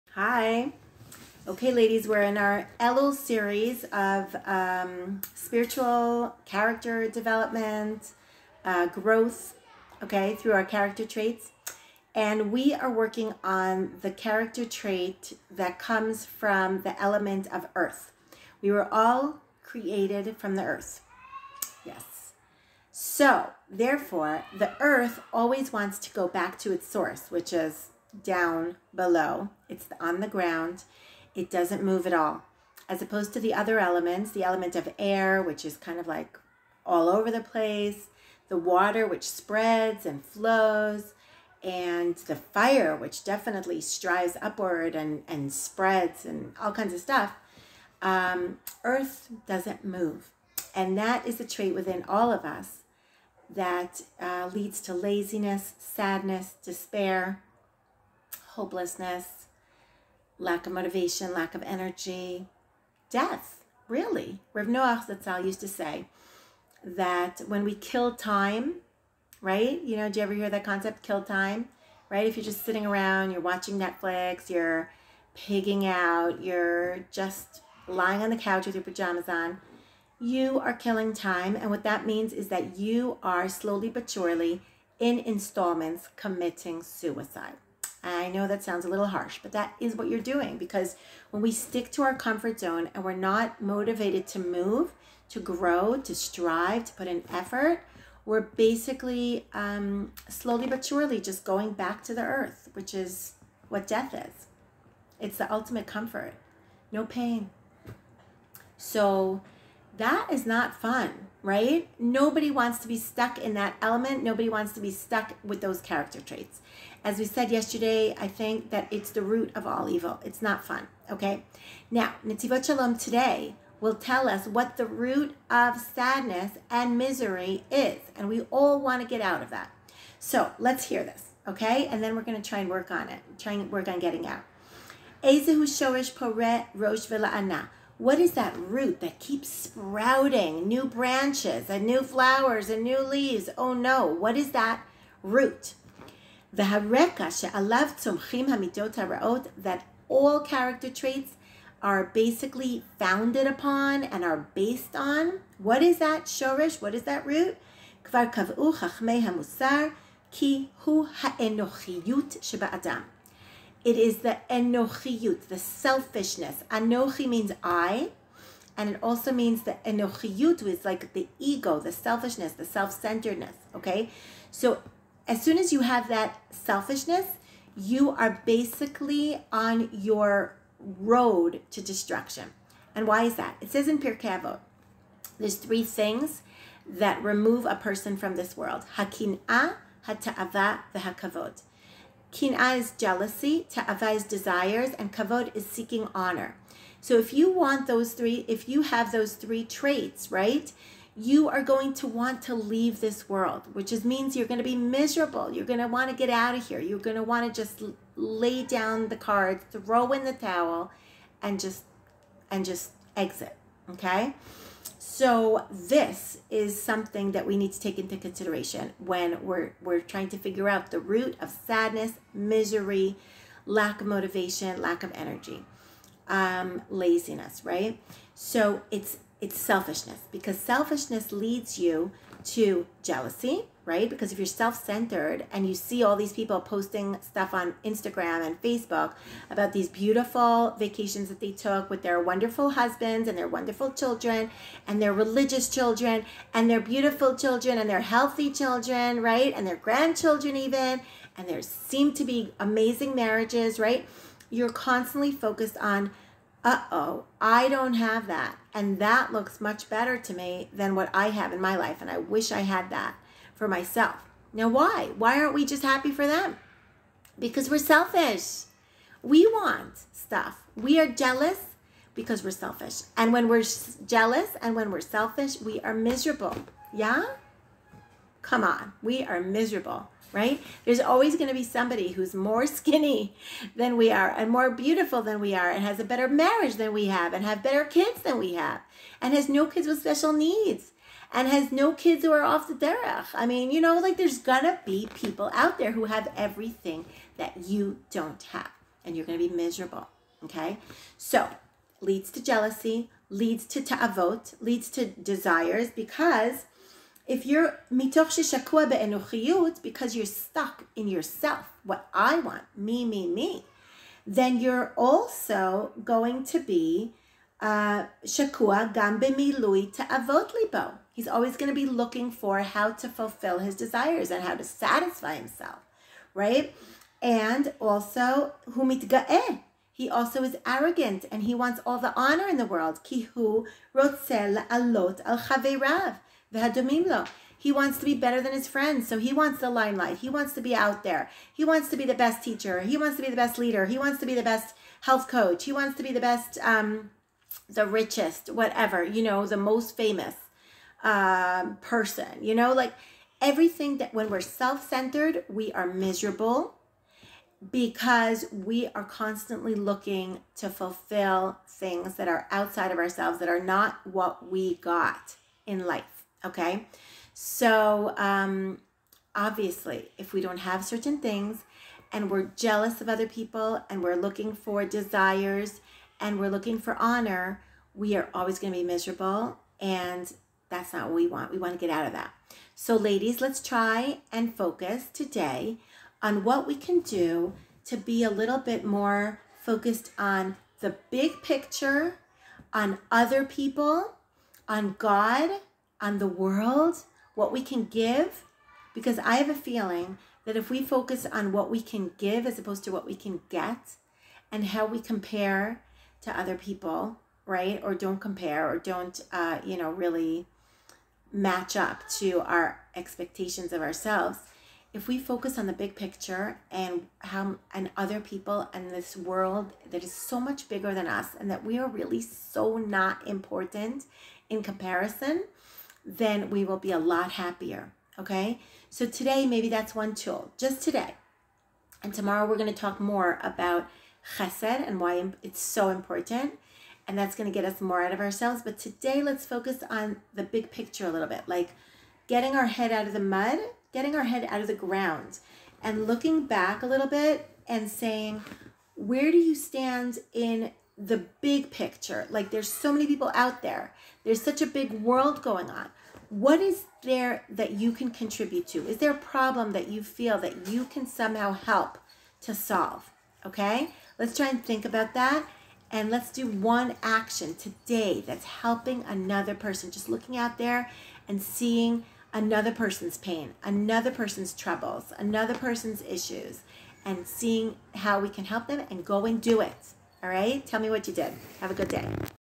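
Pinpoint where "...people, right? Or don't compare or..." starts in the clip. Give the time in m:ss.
6:46.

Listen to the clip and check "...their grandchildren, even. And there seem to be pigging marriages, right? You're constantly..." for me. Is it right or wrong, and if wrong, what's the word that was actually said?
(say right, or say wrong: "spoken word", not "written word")
wrong: "amazing", not "pigging".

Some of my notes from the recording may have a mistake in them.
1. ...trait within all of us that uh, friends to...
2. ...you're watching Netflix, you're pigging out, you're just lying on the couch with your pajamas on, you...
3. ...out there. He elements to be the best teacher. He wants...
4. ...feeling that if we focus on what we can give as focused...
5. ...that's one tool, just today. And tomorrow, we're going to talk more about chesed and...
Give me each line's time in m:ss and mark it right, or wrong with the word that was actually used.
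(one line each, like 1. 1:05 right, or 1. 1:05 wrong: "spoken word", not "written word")
1. 0:51 wrong: "leads", not "friends"
2. 1:13 right
3. 5:40 wrong: "wants", not "elements"
4. 6:39 wrong: "opposed", not "focused"
5. 7:09 right.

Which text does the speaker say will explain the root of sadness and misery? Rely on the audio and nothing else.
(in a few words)
Netivot Shalom.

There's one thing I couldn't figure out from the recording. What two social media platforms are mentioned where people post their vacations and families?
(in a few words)
Instagram and Facebook.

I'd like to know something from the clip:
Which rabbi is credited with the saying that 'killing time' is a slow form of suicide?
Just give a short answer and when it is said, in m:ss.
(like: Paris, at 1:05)
Rav Noach, at 1:04.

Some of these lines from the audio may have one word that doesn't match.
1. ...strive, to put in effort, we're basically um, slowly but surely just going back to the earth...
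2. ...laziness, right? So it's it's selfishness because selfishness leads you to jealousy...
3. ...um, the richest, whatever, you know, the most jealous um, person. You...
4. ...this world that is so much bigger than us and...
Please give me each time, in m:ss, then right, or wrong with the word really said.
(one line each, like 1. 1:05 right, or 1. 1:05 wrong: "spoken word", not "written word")
1. 1:36 right
2. 3:46 right
3. 5:46 wrong: "famous", not "jealous"
4. 6:58 right.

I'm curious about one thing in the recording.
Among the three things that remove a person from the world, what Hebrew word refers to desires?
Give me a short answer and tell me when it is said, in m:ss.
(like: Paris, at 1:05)
Ta'ava, at 3:10.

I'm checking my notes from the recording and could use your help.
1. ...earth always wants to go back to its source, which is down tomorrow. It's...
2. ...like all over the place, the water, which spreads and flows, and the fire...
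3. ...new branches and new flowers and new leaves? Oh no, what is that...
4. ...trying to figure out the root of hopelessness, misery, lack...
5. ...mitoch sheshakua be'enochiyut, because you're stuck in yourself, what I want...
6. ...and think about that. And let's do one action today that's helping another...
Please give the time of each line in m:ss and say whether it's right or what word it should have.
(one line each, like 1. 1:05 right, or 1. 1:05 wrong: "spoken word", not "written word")
1. 0:24 wrong: "below", not "tomorrow"
2. 0:36 right
3. 2:20 right
4. 3:39 wrong: "sadness", not "hopelessness"
5. 5:07 right
6. 7:44 right.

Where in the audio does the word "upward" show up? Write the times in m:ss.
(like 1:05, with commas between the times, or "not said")
0:44.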